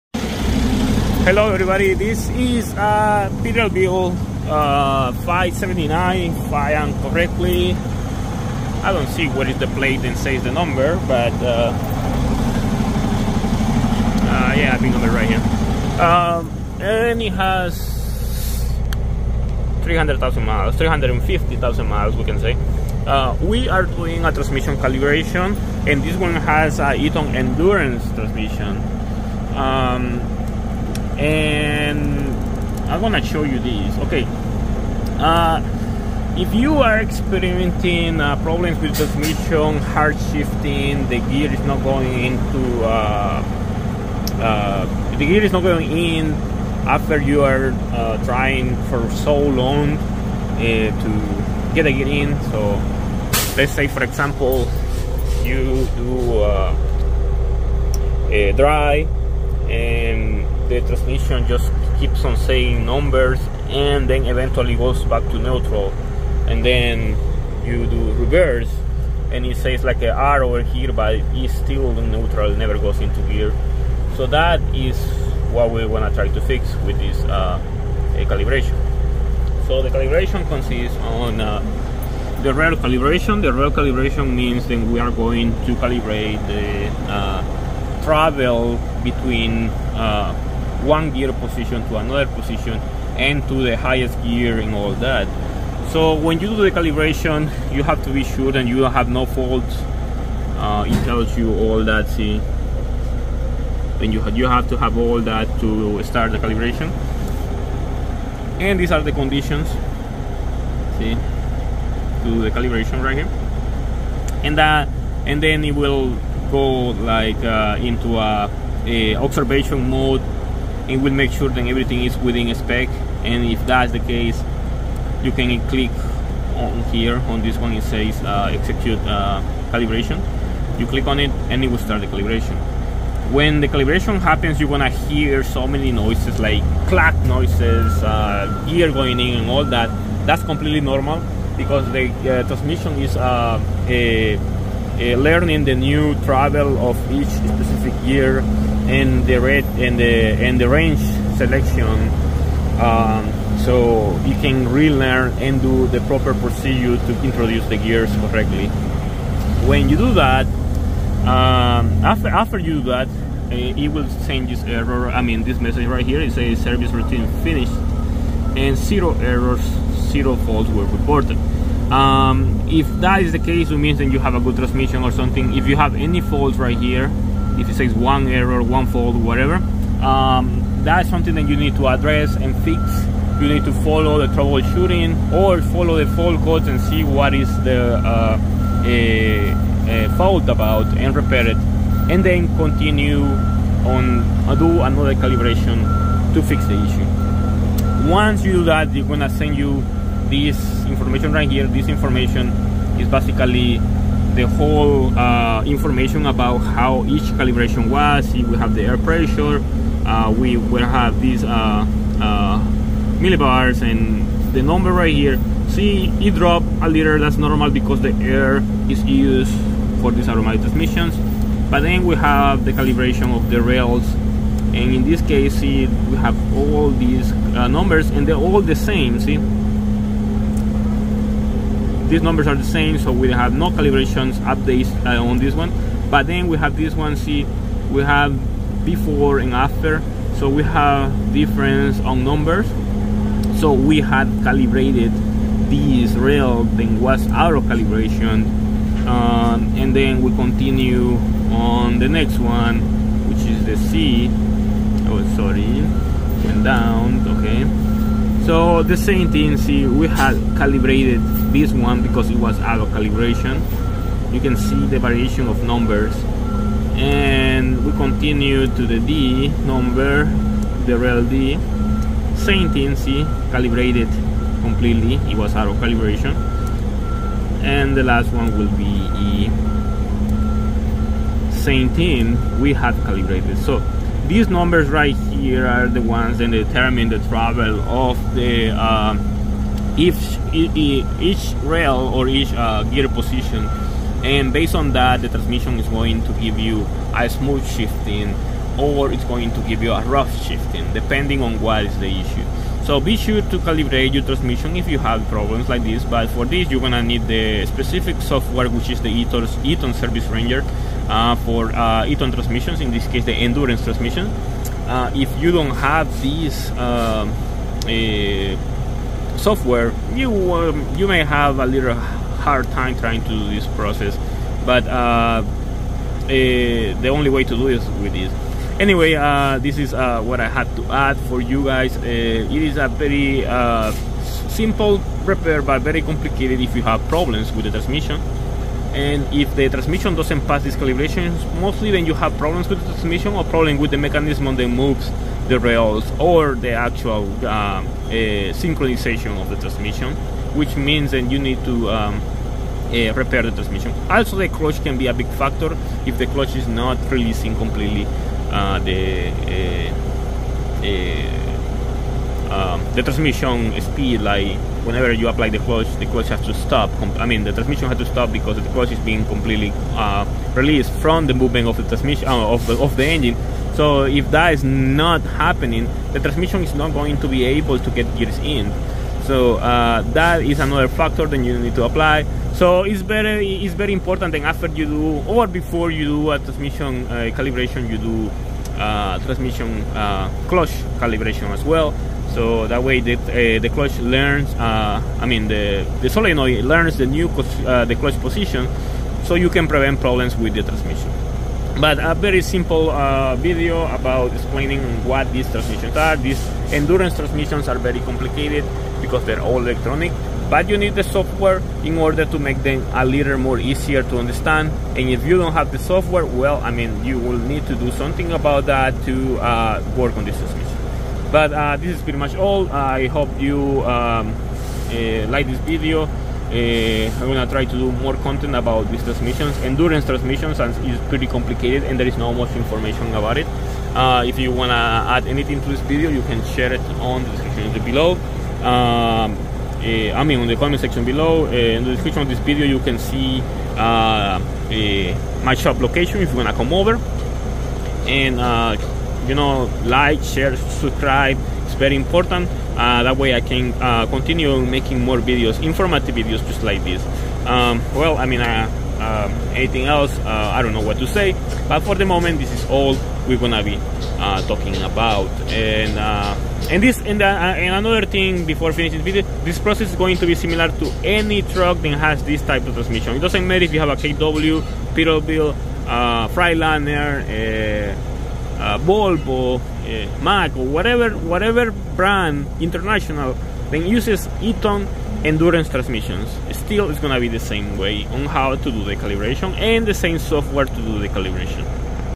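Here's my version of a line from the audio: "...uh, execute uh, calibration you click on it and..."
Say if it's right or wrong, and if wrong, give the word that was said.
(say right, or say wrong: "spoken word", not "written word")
right.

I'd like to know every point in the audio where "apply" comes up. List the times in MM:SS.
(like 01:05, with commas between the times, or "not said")
06:05, 06:21.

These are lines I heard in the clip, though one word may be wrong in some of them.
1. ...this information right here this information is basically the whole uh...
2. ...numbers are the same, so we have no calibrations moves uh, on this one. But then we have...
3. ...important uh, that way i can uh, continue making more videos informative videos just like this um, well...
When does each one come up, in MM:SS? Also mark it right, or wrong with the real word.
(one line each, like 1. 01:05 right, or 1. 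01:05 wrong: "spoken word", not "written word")
1. 03:20 right
2. 03:52 wrong: "updates", not "moves"
3. 07:31 right.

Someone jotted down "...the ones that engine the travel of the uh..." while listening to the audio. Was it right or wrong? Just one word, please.
wrong.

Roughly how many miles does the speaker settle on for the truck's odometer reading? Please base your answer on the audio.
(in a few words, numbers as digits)
350,000.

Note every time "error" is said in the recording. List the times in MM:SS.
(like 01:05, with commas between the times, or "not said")
02:44, 02:49, 02:58.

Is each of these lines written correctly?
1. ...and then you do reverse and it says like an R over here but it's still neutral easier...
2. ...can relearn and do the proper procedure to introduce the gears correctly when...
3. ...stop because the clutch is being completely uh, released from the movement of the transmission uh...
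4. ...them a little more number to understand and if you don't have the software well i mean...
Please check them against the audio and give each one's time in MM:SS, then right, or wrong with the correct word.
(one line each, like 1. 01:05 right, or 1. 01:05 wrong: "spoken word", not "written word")
1. 01:06 wrong: "never", not "easier"
2. 02:34 right
3. 06:08 right
4. 06:52 wrong: "easier", not "number".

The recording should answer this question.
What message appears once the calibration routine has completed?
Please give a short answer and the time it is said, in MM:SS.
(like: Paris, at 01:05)
Service routine finished, at 02:46.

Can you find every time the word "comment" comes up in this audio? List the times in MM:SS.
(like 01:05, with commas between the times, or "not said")
07:20.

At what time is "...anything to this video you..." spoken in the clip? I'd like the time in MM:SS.
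07:15.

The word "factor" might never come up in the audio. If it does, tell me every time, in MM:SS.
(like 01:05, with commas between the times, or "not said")
05:55, 06:20.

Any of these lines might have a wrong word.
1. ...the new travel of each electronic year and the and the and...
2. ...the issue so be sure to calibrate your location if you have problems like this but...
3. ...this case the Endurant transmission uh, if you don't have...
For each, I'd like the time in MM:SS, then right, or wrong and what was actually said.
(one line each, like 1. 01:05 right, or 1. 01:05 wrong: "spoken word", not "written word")
1. 02:25 wrong: "specific", not "electronic"
2. 05:01 wrong: "transmission", not "location"
3. 05:12 right.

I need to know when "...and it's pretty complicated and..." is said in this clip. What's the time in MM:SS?
07:10.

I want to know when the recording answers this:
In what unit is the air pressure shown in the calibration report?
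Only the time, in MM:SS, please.
03:33.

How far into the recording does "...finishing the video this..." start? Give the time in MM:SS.
07:48.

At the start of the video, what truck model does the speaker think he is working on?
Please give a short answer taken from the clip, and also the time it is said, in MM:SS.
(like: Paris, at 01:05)
Peterbilt 579, at 00:03.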